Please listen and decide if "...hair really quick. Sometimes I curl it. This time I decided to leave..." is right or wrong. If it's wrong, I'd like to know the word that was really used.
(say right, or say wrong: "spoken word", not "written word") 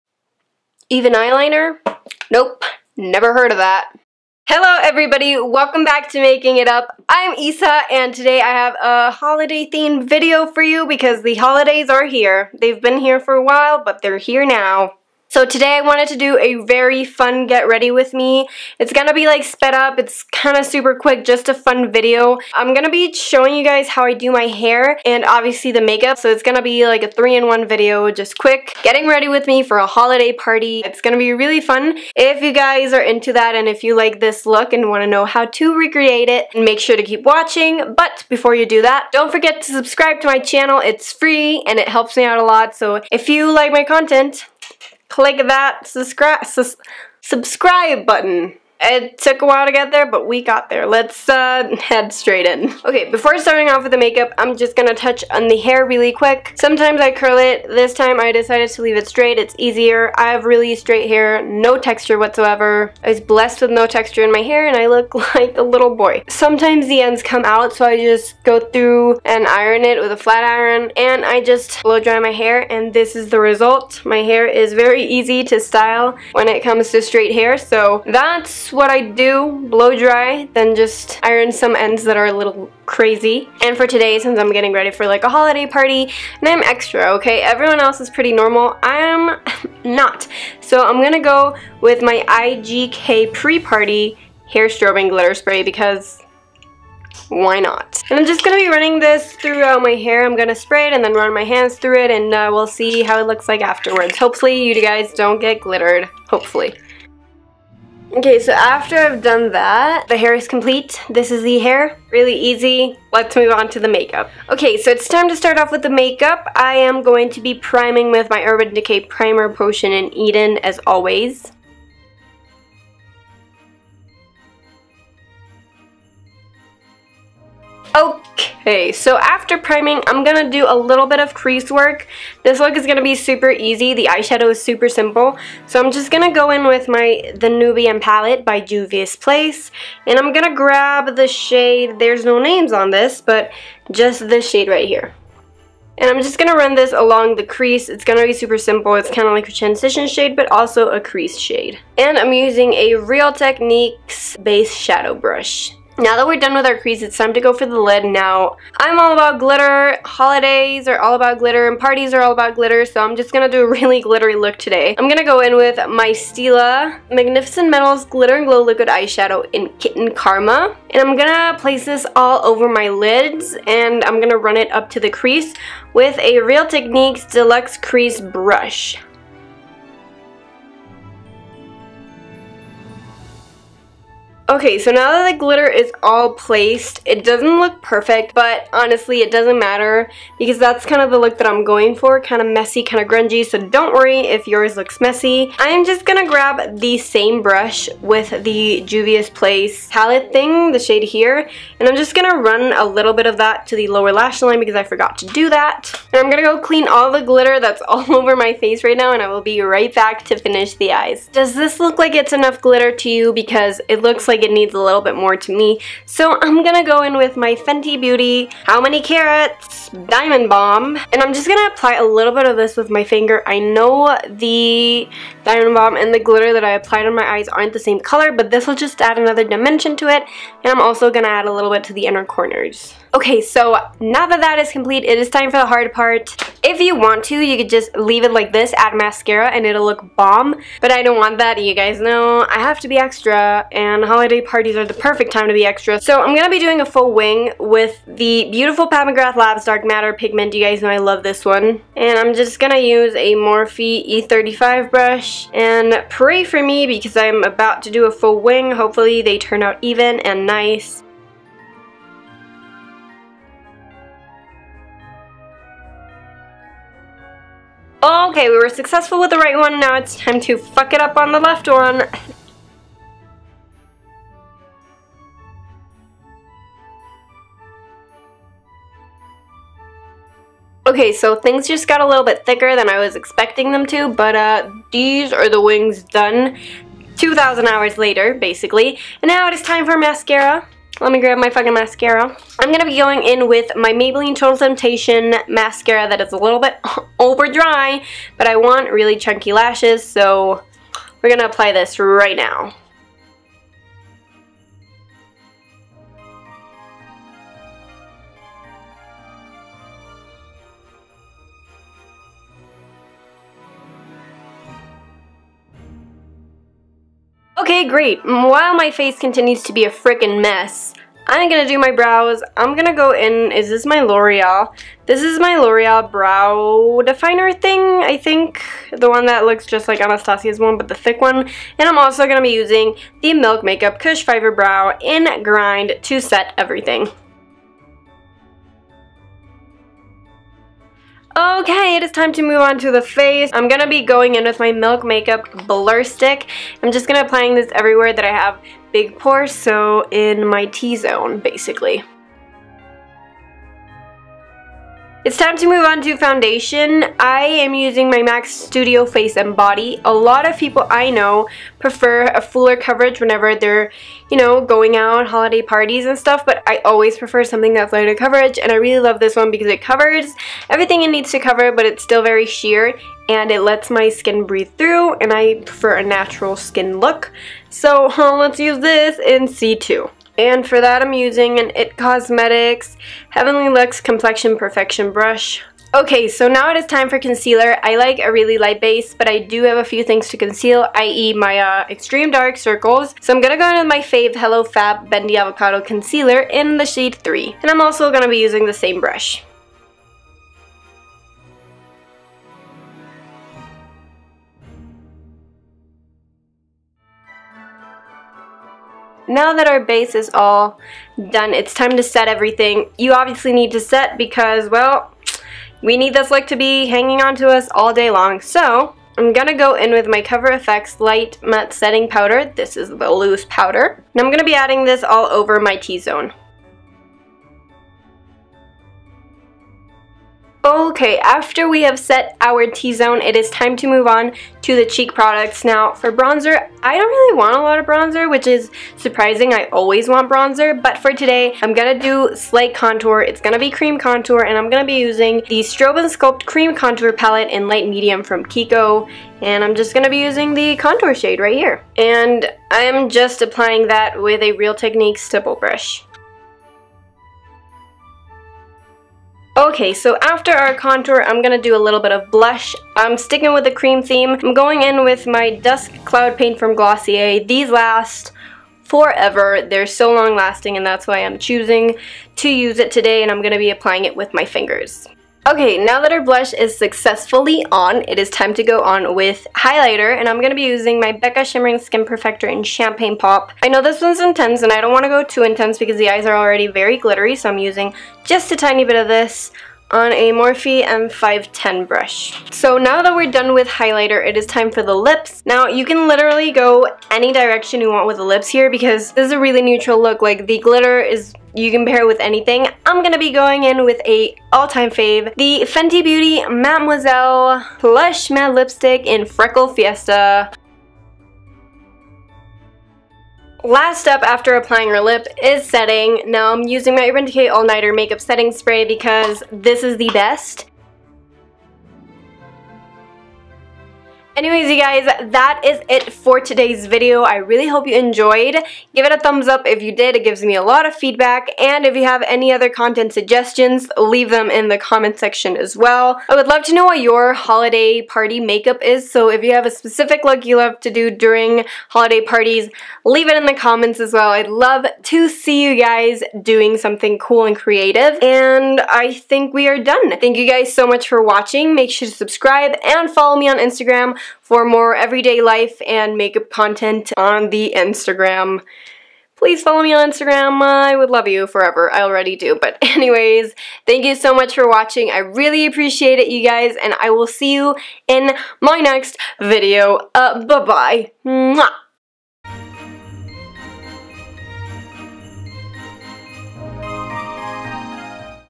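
right.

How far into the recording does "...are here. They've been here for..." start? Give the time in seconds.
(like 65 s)
11 s.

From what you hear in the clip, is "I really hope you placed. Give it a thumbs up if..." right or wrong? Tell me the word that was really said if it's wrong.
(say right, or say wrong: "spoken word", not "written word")
wrong: "enjoyed", not "placed".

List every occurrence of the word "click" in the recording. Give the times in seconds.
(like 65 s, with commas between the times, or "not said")
45 s.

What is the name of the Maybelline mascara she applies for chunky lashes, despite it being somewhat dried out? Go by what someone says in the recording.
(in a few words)
Total Temptation.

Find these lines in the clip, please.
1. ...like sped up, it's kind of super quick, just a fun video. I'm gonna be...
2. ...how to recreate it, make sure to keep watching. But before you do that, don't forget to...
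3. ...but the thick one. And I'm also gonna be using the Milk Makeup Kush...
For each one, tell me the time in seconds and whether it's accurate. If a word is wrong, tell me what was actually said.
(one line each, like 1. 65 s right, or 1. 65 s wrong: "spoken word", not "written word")
1. 19 s right
2. 35 s right
3. 330 s right.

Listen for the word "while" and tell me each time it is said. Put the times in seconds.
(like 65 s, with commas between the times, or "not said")
13 s, 49 s, 318 s.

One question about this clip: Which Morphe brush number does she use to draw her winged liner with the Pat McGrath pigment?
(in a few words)
E35.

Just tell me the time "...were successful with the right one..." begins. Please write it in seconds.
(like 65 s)
268 s.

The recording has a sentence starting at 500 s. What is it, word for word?
Like the glitter is you can pair it with anything.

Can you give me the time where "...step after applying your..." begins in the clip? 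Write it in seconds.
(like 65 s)
514 s.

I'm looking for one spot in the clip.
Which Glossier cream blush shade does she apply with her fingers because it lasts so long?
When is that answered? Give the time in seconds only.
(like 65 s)
465 s.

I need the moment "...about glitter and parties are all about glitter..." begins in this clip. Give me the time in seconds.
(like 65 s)
161 s.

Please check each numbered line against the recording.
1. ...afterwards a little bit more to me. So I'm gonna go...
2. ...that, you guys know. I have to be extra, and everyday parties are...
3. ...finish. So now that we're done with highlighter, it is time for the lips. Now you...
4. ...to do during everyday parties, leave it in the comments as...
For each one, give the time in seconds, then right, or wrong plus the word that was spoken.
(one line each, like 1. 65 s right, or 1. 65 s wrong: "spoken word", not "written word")
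1. 214 s wrong: "needs", not "afterwards"
2. 241 s wrong: "holiday", not "everyday"
3. 491 s wrong: "brush", not "finish"
4. 540 s wrong: "holiday", not "everyday".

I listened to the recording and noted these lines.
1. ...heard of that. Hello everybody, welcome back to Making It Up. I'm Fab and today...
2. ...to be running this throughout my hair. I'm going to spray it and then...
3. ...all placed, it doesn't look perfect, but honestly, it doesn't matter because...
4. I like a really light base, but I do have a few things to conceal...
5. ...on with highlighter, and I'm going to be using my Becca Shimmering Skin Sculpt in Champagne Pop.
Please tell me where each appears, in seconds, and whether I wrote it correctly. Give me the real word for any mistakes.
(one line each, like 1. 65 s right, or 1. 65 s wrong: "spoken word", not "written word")
1. 3 s wrong: "Isa", not "Fab"
2. 98 s right
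3. 186 s right
4. 387 s right
5. 478 s wrong: "Perfector", not "Sculpt".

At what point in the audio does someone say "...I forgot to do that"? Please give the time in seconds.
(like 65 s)
204 s.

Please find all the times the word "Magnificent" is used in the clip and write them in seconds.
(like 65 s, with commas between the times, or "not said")
167 s.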